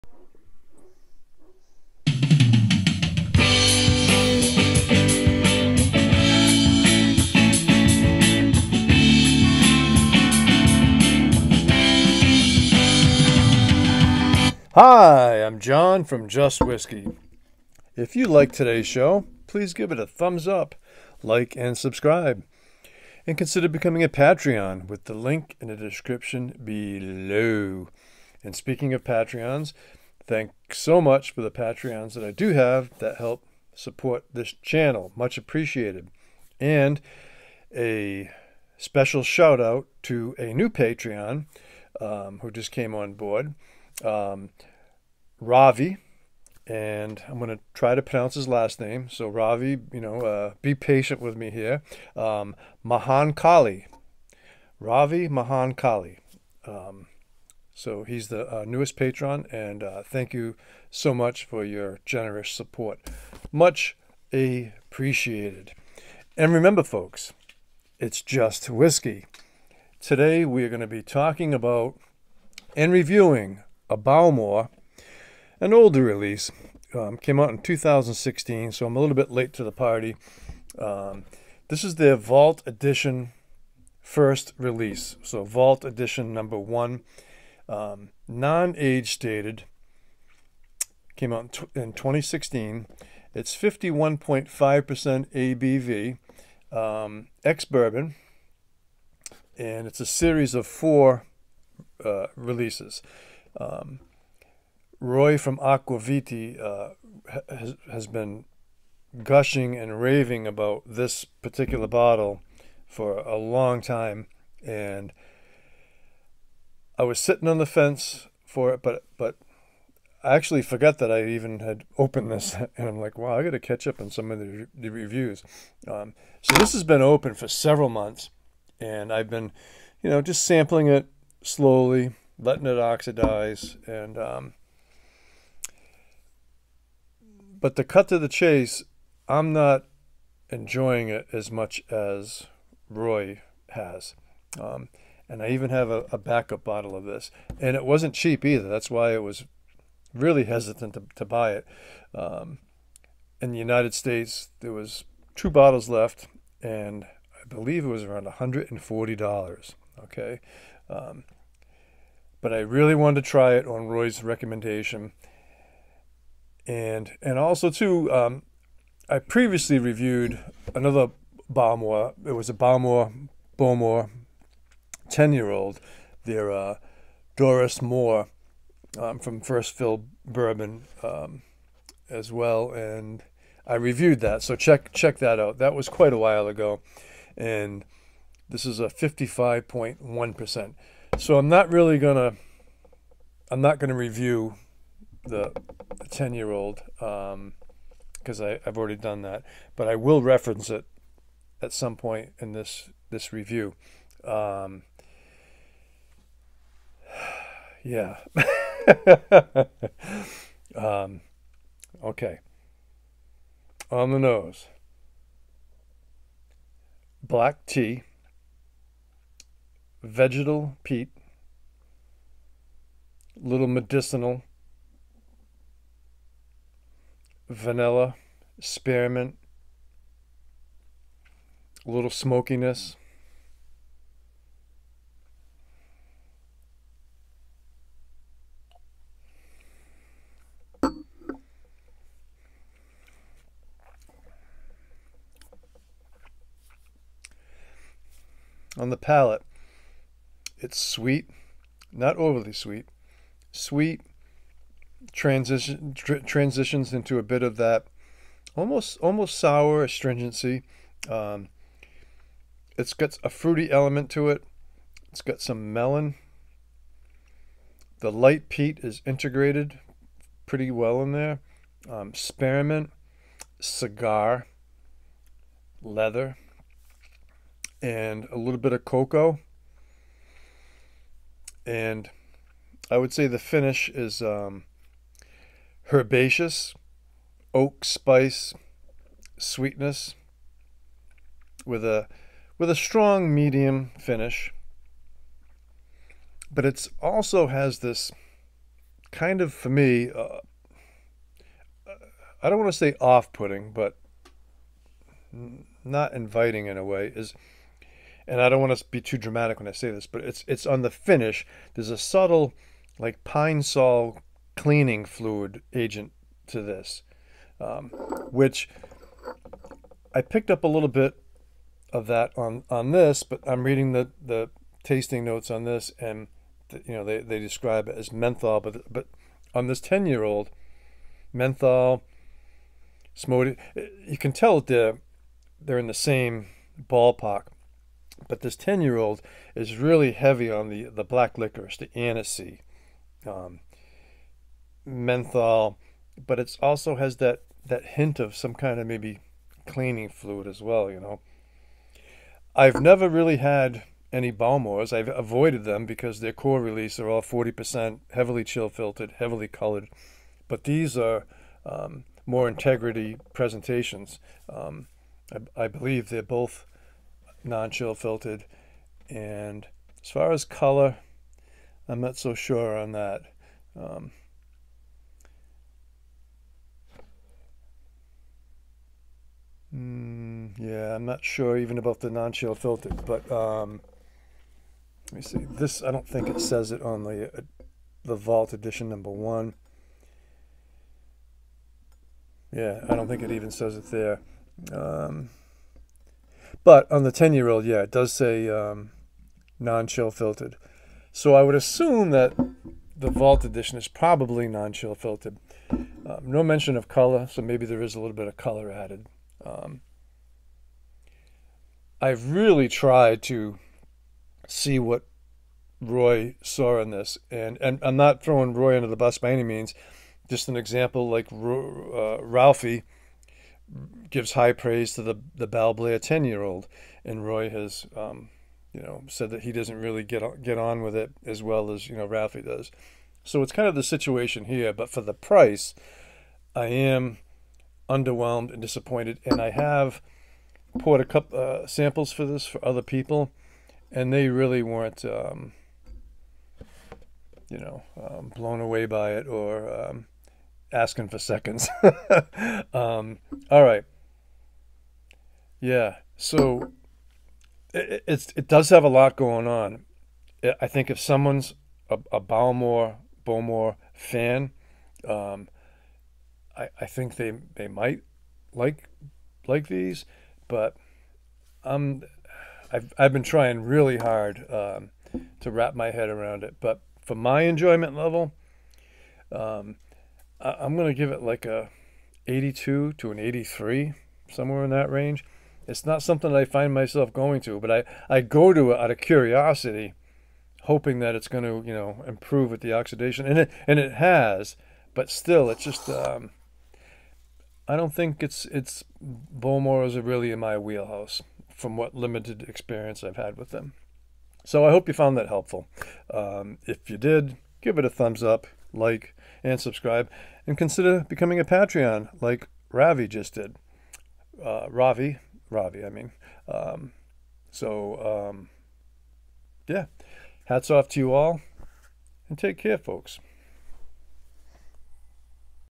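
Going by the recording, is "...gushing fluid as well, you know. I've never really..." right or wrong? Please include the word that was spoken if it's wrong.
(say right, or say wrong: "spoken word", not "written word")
wrong: "cleaning", not "gushing".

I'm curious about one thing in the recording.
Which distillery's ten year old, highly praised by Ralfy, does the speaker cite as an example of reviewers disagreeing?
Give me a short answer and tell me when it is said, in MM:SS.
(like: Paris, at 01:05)
Balblair, at 07:05.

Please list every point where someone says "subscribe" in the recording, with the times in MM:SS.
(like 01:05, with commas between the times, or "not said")
00:21, 08:29.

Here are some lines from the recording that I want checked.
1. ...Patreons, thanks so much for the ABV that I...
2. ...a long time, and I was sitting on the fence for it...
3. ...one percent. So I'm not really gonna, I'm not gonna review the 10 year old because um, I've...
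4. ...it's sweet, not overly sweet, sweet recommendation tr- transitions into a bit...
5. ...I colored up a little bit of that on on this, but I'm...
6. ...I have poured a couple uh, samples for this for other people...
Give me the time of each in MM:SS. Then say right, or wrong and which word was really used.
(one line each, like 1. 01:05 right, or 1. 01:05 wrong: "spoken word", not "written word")
1. 00:29 wrong: "Patreons", not "ABV"
2. 01:53 right
3. 03:10 right
4. 04:10 wrong: "transition", not "recommendation"
5. 05:20 wrong: "picked", not "colored"
6. 07:19 right.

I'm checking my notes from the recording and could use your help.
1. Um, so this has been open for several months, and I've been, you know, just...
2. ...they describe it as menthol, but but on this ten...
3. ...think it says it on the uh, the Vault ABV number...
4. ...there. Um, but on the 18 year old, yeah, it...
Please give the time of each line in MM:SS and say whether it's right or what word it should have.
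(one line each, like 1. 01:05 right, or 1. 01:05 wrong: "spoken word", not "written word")
1. 02:05 right
2. 05:27 right
3. 06:26 wrong: "Edition", not "ABV"
4. 06:33 wrong: "10", not "18".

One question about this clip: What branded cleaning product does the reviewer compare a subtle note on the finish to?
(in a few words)
Pine-Sol.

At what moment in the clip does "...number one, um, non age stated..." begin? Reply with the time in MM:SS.
01:26.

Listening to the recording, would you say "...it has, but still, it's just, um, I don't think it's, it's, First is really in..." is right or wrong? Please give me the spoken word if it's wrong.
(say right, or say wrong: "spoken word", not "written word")
wrong: "Bowmore", not "First".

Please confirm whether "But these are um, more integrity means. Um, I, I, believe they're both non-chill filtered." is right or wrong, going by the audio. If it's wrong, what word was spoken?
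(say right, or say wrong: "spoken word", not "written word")
wrong: "presentations", not "means".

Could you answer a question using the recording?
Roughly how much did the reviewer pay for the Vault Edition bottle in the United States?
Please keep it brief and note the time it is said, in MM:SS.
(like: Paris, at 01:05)
$140, at 02:38.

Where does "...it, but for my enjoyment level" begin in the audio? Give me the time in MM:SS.
07:56.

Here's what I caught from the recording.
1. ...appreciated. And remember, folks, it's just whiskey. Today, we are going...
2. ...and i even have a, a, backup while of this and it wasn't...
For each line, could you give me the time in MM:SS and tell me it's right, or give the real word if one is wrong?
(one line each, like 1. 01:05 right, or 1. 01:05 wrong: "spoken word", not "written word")
1. 01:04 right
2. 02:25 wrong: "bottle", not "while".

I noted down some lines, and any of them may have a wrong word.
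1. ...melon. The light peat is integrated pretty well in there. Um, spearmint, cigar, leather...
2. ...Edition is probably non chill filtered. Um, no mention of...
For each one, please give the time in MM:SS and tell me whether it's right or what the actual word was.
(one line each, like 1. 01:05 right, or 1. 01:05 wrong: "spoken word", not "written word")
1. 04:25 right
2. 06:43 right.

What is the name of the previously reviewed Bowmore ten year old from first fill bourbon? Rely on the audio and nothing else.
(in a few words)
Dorus Mor.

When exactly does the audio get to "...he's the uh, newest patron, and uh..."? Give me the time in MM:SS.
00:58.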